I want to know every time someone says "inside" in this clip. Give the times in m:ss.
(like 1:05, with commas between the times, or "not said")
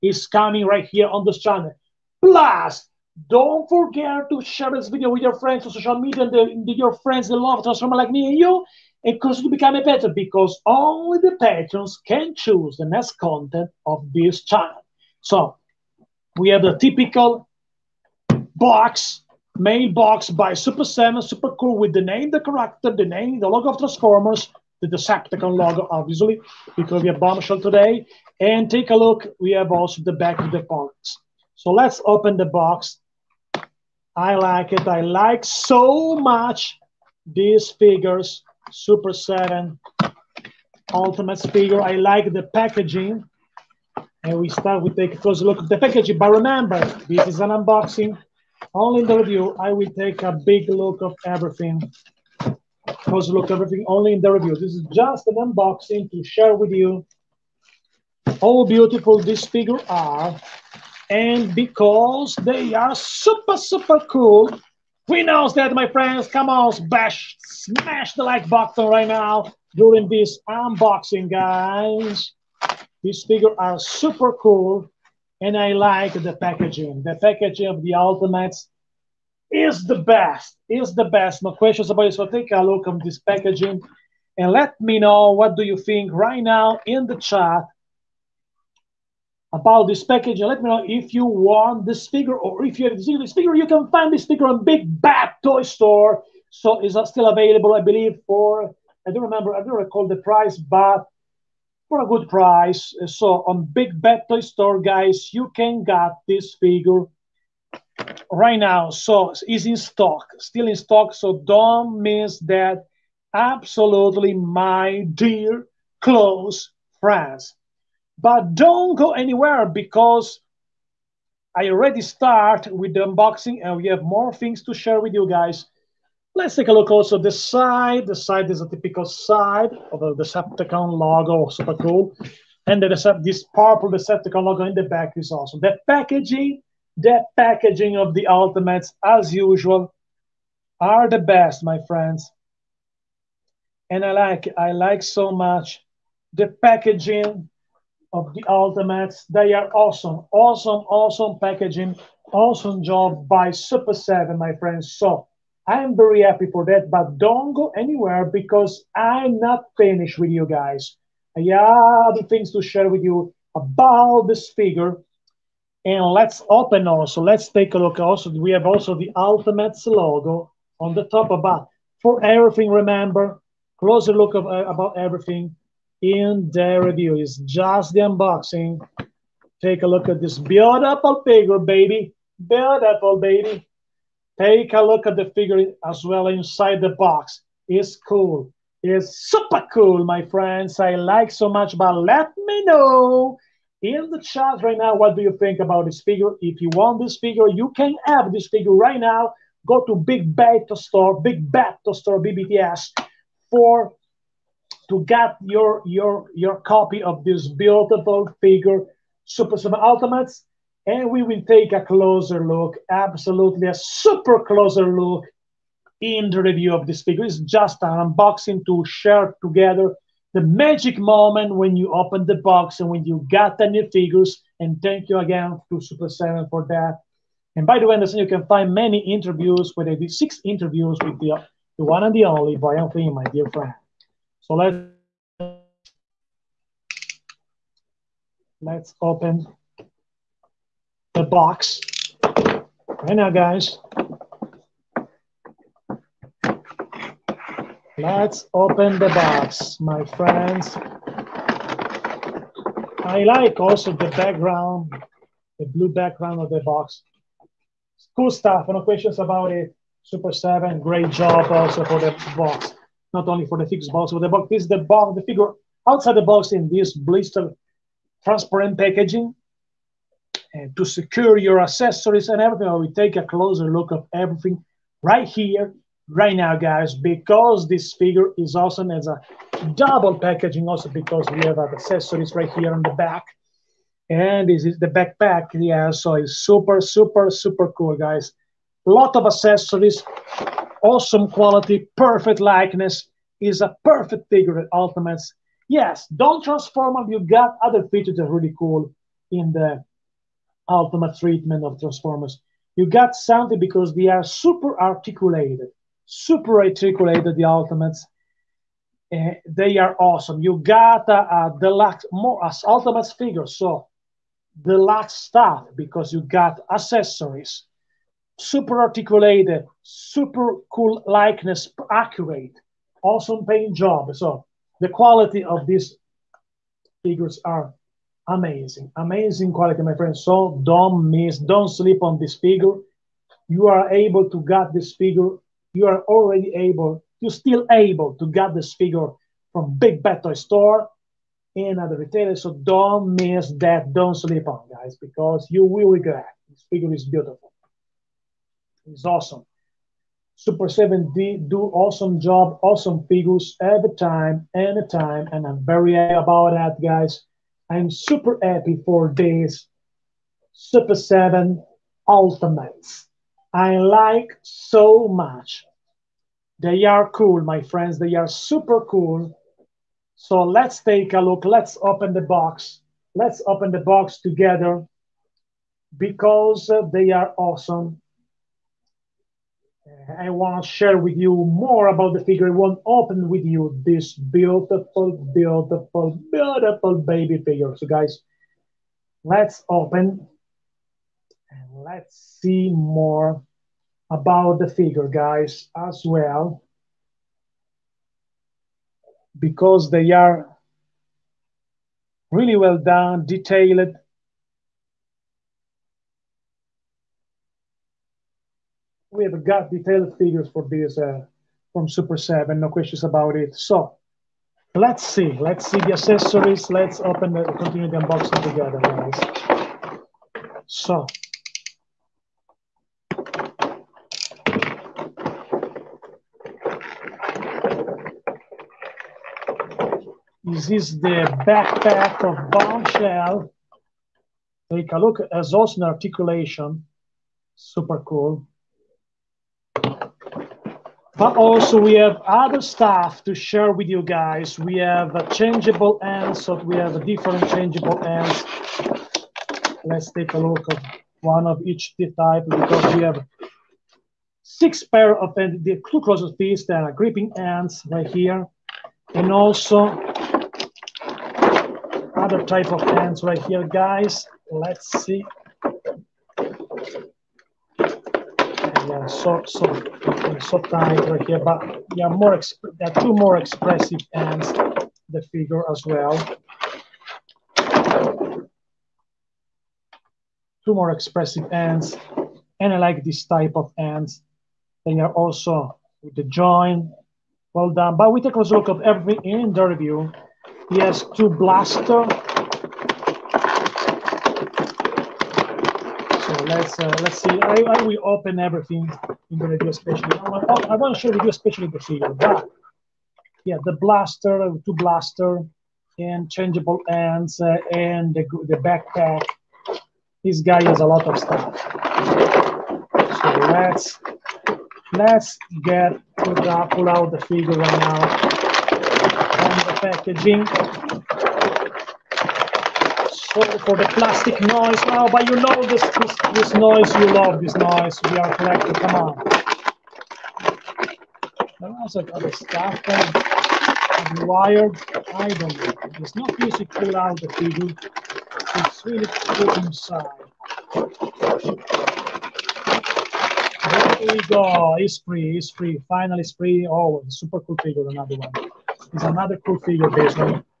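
3:06, 8:59.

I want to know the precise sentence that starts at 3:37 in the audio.
It's just an unboxing to share together the magic moment when you open the box and when you got the new figures.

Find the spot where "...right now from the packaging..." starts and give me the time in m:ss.
8:37.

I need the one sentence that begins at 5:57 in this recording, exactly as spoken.
I'm super happy for this Super 7 Ultimates.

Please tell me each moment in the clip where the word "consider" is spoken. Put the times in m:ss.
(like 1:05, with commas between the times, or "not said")
0:09.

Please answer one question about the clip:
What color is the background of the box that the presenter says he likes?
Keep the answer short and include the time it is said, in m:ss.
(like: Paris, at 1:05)
Blue, at 4:15.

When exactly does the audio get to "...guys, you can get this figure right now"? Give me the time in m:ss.
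1:44.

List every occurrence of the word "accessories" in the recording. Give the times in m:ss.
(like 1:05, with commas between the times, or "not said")
4:31, 4:41, 4:49, 5:16, 6:55.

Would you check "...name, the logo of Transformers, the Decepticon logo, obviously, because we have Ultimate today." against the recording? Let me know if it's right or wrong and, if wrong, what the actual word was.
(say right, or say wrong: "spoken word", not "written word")
wrong: "Bombshell", not "Ultimate".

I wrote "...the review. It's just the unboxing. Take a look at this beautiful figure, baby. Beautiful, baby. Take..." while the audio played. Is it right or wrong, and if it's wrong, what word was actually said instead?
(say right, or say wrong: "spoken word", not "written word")
right.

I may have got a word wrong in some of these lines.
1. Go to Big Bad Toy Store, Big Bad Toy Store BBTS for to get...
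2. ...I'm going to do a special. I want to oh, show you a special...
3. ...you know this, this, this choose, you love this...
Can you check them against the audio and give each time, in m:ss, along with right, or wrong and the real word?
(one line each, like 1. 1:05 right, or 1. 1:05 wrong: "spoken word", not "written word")
1. 3:19 right
2. 8:19 right
3. 8:45 wrong: "noise", not "choose".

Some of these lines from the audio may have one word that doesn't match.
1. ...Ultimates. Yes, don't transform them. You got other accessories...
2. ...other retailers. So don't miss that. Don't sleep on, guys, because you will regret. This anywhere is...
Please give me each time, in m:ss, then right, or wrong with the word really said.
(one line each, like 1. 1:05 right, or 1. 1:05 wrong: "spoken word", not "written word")
1. 4:54 wrong: "features", not "accessories"
2. 5:41 wrong: "figure", not "anywhere".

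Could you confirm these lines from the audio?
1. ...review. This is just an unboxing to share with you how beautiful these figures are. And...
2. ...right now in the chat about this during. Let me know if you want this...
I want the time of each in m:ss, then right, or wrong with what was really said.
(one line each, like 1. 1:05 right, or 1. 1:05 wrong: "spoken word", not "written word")
1. 0:54 right
2. 1:26 wrong: "packaging", not "during".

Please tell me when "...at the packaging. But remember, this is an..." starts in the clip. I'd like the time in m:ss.
0:45.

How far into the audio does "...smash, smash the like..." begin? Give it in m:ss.
1:06.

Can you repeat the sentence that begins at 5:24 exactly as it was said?
So the quality of these figures are amazing, amazing quality, my friend.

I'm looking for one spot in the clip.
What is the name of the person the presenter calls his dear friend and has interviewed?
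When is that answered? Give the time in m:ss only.
3:52.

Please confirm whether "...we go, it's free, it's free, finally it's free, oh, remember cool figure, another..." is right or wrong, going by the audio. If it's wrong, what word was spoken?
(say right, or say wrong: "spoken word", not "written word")
wrong: "super", not "remember".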